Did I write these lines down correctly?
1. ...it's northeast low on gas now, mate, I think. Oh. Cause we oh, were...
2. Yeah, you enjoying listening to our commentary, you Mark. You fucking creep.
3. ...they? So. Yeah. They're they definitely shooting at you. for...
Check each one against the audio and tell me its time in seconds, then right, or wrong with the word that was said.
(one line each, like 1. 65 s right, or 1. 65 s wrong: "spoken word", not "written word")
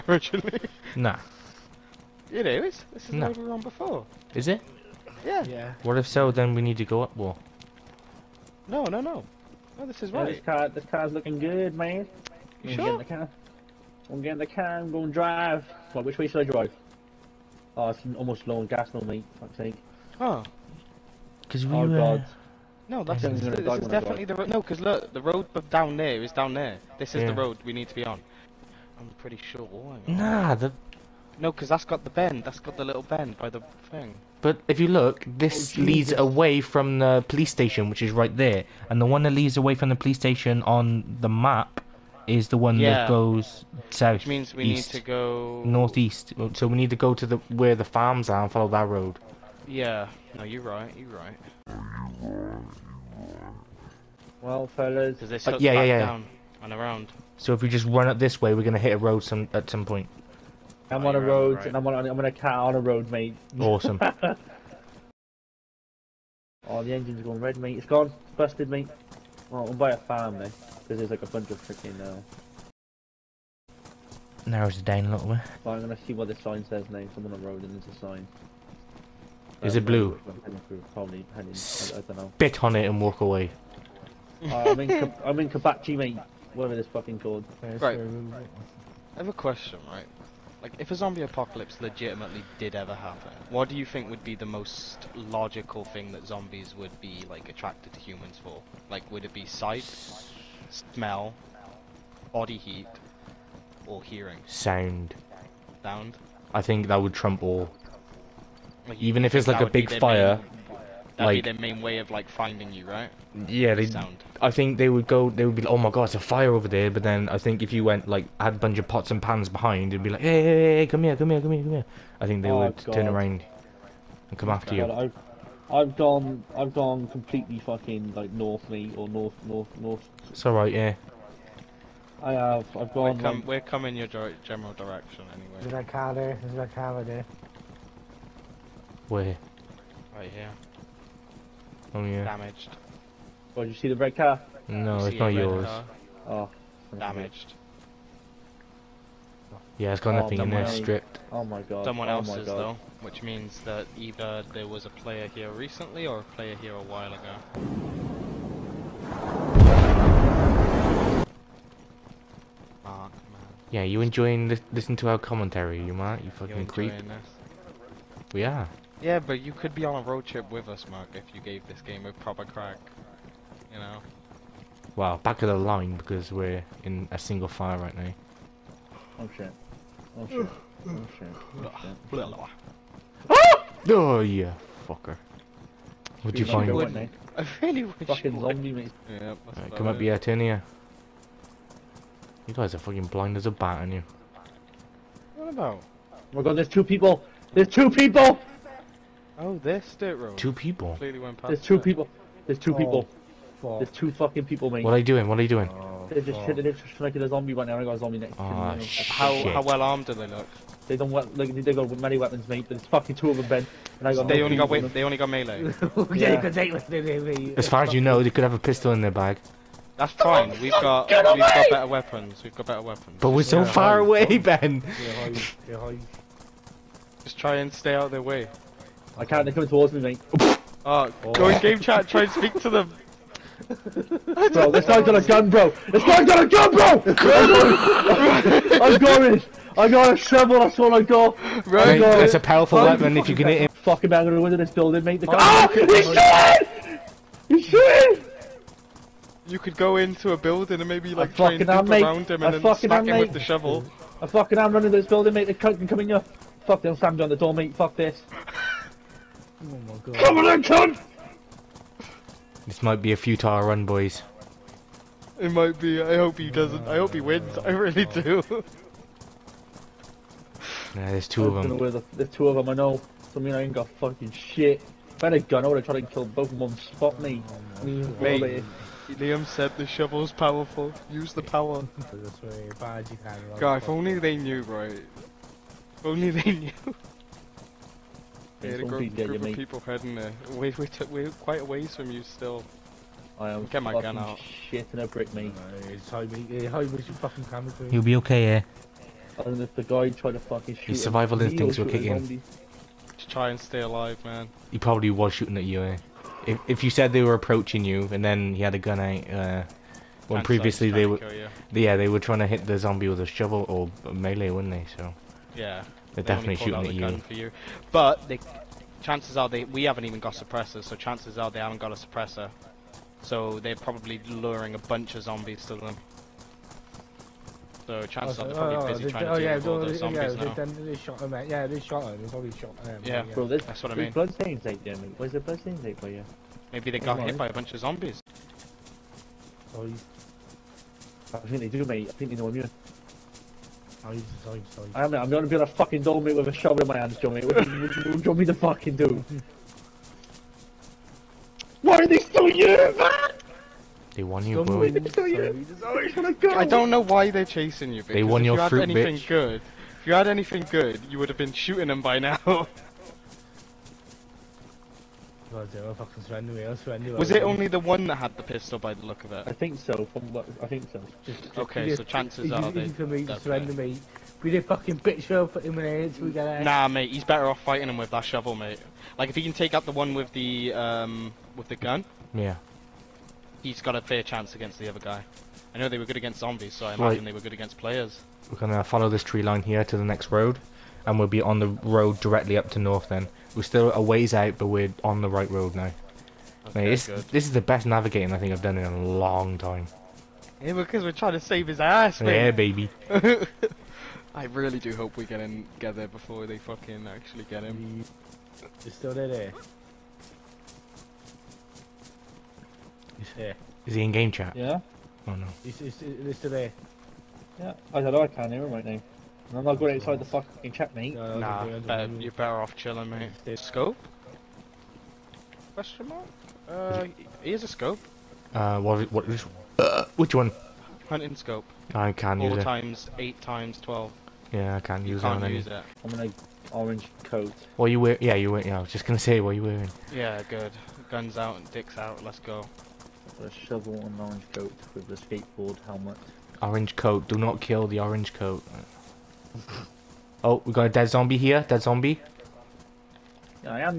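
1. 17 s wrong: "almost", not "northeast"
2. 163 s right
3. 314 s right.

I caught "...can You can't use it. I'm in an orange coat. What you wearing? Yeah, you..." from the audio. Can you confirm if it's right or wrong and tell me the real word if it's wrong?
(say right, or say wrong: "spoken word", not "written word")
right.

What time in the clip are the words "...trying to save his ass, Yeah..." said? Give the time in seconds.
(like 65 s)
401 s.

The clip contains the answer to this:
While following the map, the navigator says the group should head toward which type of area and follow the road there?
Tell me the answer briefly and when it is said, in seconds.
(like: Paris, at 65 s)
the farms, at 47 s.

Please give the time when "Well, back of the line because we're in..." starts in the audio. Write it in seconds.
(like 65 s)
174 s.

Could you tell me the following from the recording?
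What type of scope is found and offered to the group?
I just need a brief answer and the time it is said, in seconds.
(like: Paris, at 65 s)
Hunting scope, at 431 s.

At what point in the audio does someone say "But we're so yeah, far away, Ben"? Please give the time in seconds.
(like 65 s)
223 s.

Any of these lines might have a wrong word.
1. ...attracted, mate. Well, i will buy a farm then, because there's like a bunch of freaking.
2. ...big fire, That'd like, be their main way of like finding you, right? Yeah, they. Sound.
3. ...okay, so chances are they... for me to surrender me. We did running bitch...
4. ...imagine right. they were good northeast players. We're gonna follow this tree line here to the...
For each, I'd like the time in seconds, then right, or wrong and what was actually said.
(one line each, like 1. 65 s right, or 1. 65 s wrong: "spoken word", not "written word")
1. 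68 s wrong: "busted", not "attracted"
2. 109 s right
3. 371 s wrong: "fucking", not "running"
4. 386 s wrong: "against", not "northeast".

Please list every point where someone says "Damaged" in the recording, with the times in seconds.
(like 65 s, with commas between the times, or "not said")
142 s, 146 s.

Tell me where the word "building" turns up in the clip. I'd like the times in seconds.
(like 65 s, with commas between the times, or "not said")
244 s, 250 s, 255 s.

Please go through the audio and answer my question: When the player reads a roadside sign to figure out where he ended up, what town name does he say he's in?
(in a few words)
Kabachi.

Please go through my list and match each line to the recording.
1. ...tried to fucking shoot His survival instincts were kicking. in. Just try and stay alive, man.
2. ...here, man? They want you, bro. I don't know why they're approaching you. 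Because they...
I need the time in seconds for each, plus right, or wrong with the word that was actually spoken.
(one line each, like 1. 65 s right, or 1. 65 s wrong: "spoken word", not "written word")
1. 300 s right
2. 352 s wrong: "chasing", not "approaching".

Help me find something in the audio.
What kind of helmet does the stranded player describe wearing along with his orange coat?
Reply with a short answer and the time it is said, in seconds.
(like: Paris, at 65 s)
skateboard helmet, at 445 s.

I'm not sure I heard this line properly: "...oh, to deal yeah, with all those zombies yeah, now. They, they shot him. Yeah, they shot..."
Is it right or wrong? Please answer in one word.
right.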